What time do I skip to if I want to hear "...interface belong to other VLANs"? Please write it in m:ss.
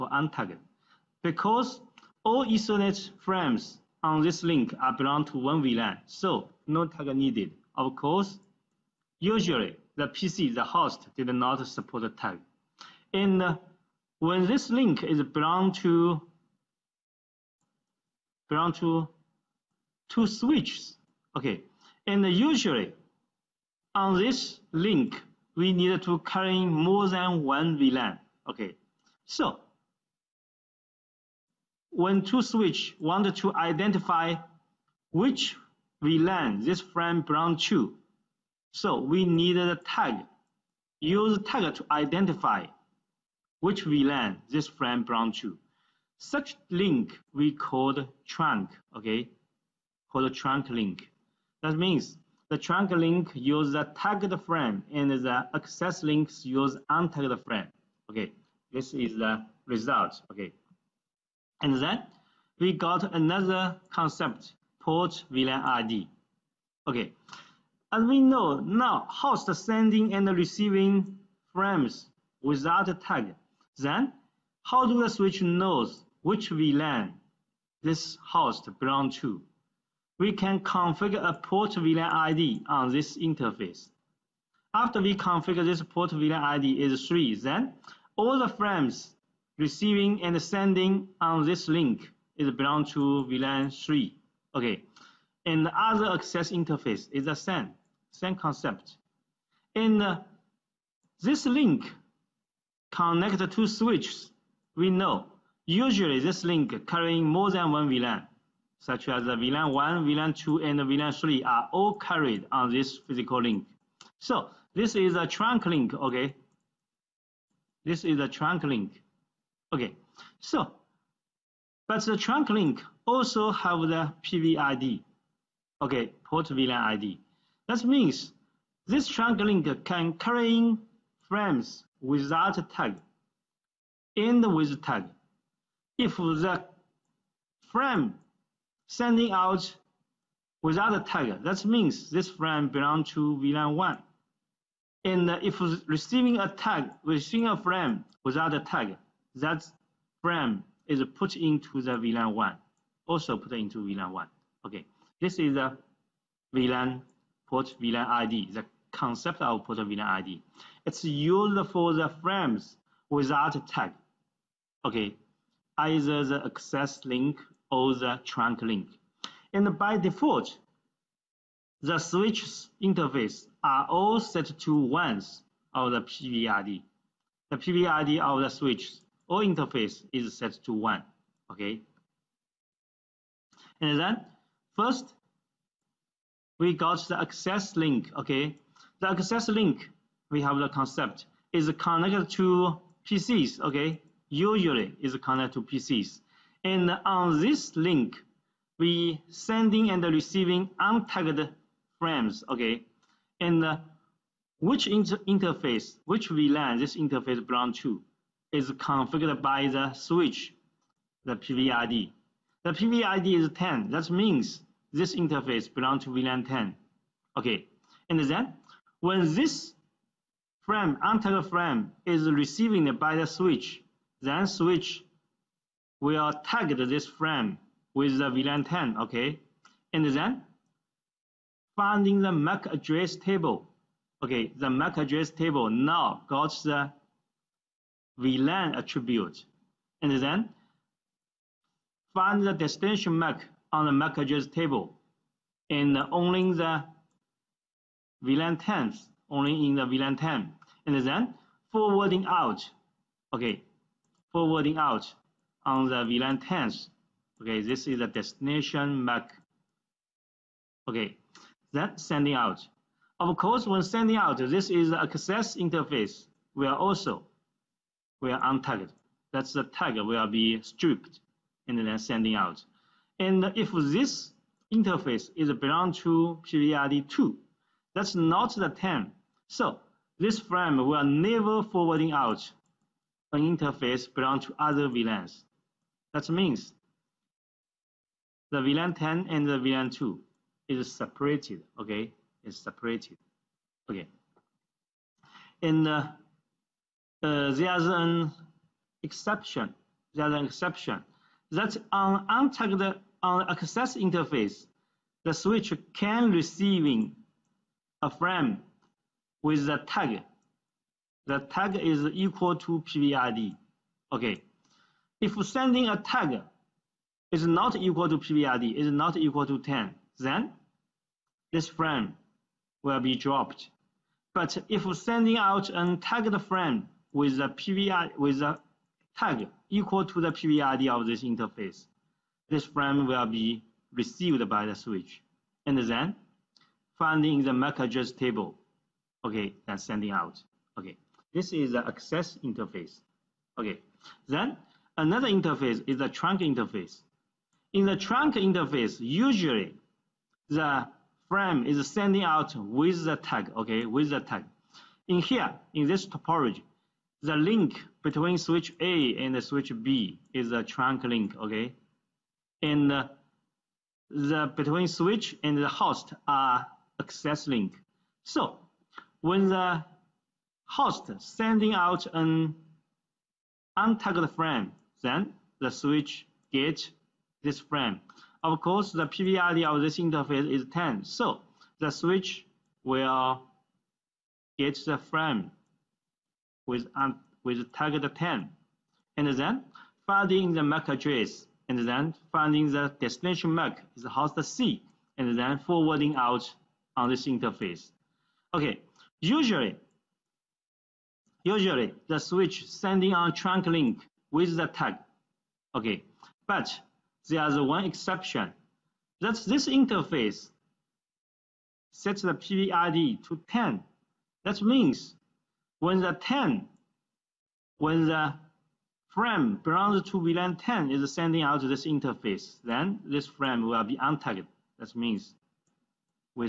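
4:43.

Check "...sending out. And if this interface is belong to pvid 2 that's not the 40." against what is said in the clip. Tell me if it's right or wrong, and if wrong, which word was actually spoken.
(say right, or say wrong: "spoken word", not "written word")
wrong: "10", not "40".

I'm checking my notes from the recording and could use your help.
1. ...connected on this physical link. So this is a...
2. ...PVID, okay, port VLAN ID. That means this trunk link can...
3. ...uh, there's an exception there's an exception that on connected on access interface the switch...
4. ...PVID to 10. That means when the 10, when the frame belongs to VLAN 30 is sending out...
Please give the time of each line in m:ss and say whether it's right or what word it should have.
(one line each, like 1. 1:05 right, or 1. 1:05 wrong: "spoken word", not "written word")
1. 1:51 wrong: "carried", not "connected"
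2. 2:04 right
3. 4:57 wrong: "untagged", not "connected"
4. 6:52 wrong: "10", not "30".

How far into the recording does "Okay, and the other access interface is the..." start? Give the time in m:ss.
1:34.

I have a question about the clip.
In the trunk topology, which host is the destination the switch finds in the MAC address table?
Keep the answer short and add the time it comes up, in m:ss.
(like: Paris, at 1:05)
Host C, at 6:34.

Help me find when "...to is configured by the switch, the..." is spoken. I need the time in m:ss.
3:27.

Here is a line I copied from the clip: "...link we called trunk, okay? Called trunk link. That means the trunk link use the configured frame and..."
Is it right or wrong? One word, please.
wrong.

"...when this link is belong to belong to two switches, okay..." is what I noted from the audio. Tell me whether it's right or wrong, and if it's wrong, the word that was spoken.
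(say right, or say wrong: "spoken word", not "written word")
right.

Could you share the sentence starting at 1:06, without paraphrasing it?
Okay, as we know now, host sending and receiving frames without a tag.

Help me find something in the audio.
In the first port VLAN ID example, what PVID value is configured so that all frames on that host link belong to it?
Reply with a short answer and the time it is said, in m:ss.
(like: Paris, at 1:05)
3, at 1:25.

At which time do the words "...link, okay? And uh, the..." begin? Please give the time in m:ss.
6:01.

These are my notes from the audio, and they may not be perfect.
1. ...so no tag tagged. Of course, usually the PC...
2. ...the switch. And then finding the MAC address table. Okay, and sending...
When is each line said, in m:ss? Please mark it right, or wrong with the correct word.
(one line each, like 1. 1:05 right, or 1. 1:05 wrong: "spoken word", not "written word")
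1. 0:06 wrong: "needed", not "tagged"
2. 5:34 right.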